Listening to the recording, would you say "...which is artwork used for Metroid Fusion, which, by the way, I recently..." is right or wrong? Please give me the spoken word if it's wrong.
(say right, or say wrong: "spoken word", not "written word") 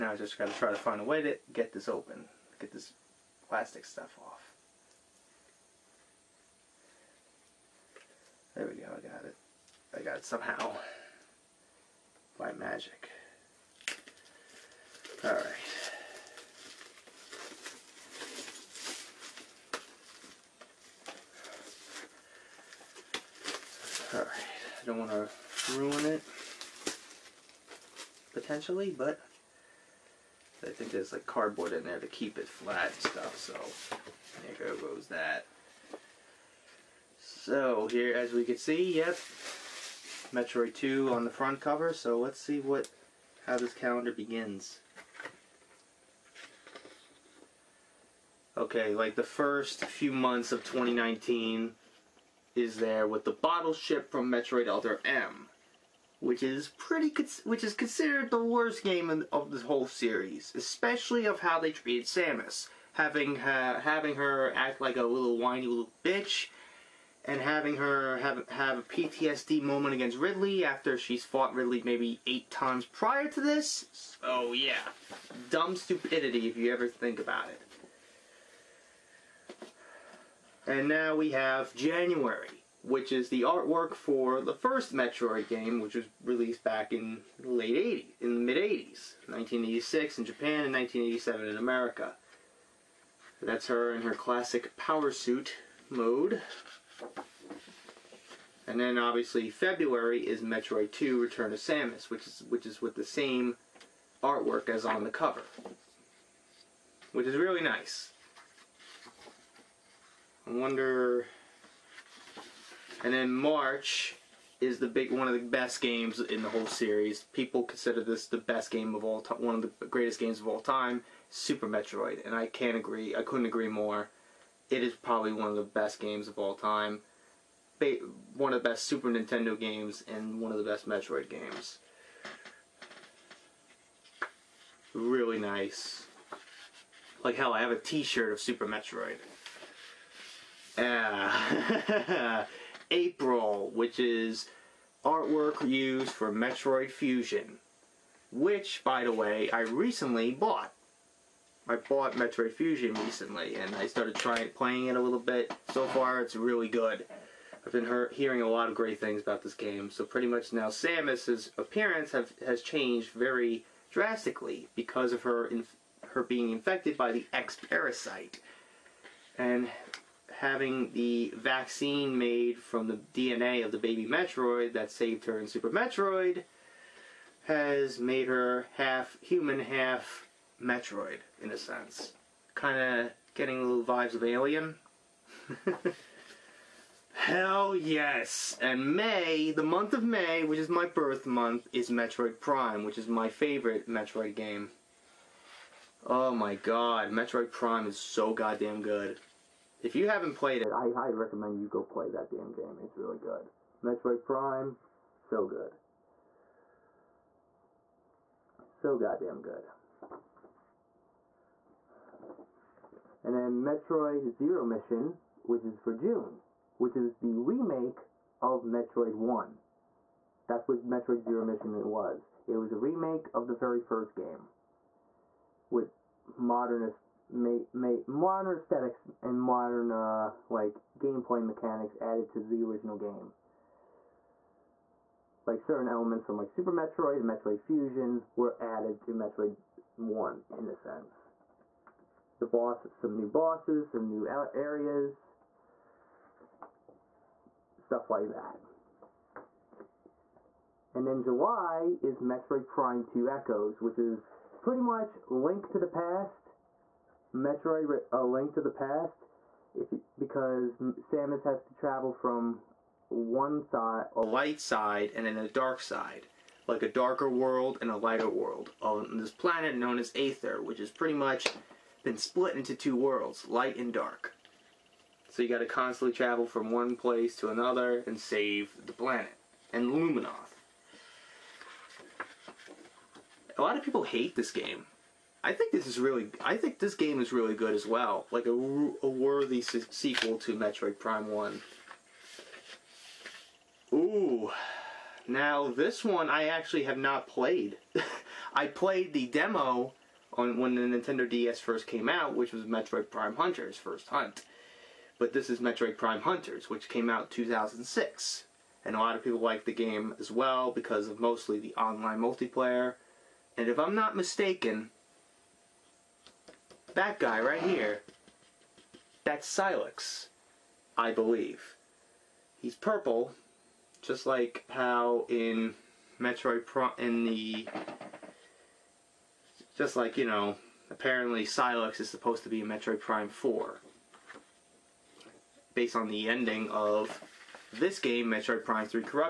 right.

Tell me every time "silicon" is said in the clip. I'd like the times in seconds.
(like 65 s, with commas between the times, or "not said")
not said.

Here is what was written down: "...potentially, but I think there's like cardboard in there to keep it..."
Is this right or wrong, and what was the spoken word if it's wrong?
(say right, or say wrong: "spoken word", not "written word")
right.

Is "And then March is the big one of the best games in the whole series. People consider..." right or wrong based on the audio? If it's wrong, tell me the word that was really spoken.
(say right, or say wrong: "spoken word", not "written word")
right.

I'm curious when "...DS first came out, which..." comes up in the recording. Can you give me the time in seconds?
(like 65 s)
301 s.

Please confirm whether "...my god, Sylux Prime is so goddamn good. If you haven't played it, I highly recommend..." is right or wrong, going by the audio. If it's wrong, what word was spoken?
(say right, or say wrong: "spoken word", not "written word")
wrong: "Metroid", not "Sylux".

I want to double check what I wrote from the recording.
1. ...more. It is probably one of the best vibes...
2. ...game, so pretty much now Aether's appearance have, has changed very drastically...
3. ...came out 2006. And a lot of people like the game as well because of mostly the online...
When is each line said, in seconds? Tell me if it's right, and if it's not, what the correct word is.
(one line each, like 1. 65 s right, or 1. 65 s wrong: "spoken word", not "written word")
1. 123 s wrong: "games", not "vibes"
2. 159 s wrong: "Samus", not "Aether"
3. 306 s right.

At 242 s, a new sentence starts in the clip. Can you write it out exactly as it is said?
The boss, some new bosses, some new areas, stuff like that.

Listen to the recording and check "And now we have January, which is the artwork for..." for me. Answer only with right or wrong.
right.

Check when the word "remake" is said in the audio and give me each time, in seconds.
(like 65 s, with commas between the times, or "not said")
217 s, 222 s.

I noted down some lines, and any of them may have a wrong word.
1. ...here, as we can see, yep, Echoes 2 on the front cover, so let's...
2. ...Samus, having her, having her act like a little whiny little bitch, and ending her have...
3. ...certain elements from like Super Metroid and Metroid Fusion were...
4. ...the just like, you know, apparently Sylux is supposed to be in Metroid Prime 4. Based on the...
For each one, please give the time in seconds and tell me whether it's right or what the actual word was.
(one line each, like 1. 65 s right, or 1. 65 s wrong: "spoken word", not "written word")
1. 37 s wrong: "Metroid", not "Echoes"
2. 62 s wrong: "having", not "ending"
3. 235 s right
4. 327 s right.